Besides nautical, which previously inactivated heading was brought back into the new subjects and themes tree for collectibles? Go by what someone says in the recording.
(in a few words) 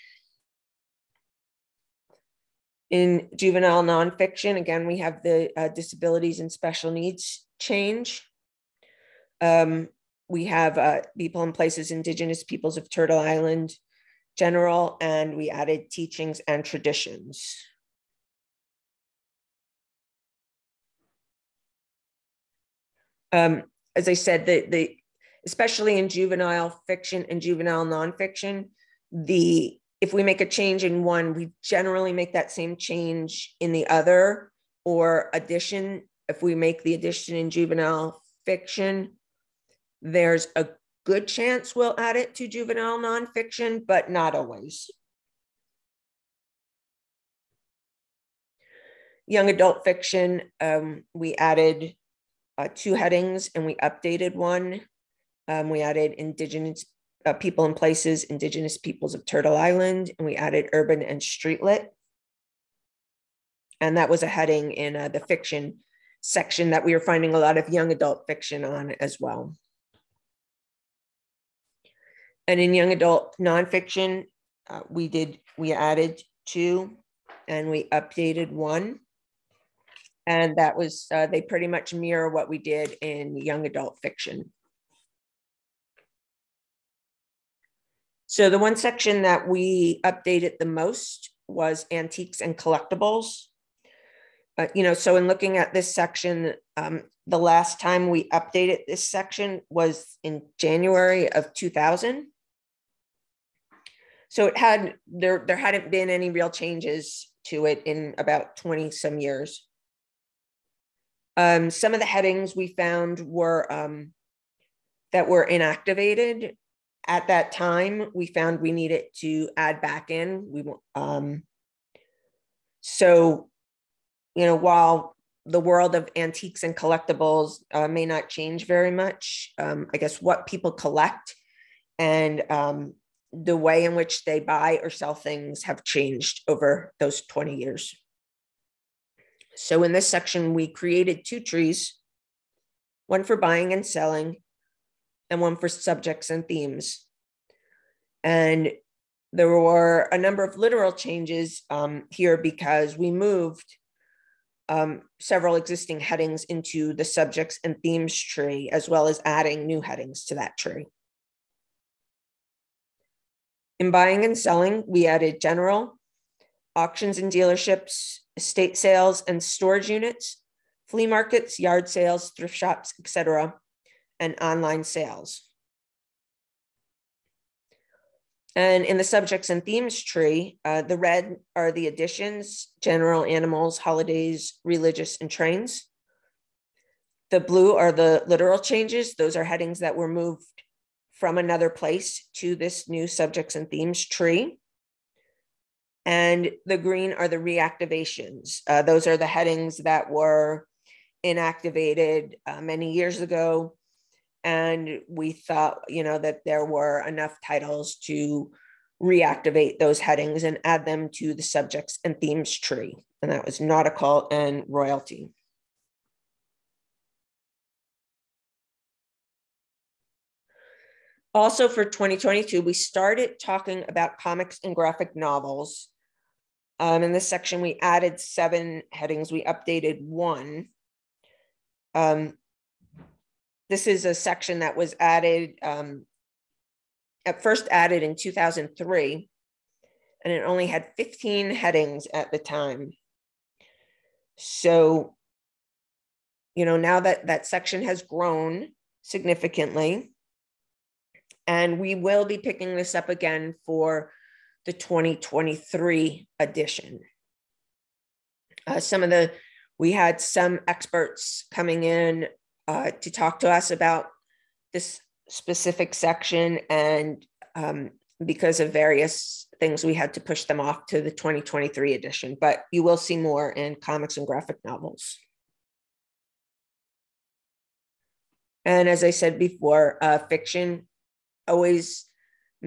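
royalty.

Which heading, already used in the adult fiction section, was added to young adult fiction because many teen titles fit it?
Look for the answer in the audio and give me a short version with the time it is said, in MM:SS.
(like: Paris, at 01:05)
urban and streetlit, at 01:00.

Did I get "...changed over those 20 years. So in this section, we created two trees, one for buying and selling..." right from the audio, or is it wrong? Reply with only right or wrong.
right.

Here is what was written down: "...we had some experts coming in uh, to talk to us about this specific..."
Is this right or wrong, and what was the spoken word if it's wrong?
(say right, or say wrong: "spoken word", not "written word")
right.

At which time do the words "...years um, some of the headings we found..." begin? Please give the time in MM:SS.
01:49.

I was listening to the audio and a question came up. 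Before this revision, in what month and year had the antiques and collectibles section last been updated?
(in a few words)
January 2000.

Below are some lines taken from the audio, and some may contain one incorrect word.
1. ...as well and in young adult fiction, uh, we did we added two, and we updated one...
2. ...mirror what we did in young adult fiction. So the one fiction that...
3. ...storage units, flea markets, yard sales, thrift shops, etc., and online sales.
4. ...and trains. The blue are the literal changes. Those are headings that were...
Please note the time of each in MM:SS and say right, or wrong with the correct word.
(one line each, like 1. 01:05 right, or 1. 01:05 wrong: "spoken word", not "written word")
1. 01:09 wrong: "nonfiction", not "fiction"
2. 01:21 wrong: "section", not "fiction"
3. 02:49 right
4. 03:05 right.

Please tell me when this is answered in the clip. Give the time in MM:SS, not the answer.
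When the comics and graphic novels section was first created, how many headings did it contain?
04:00.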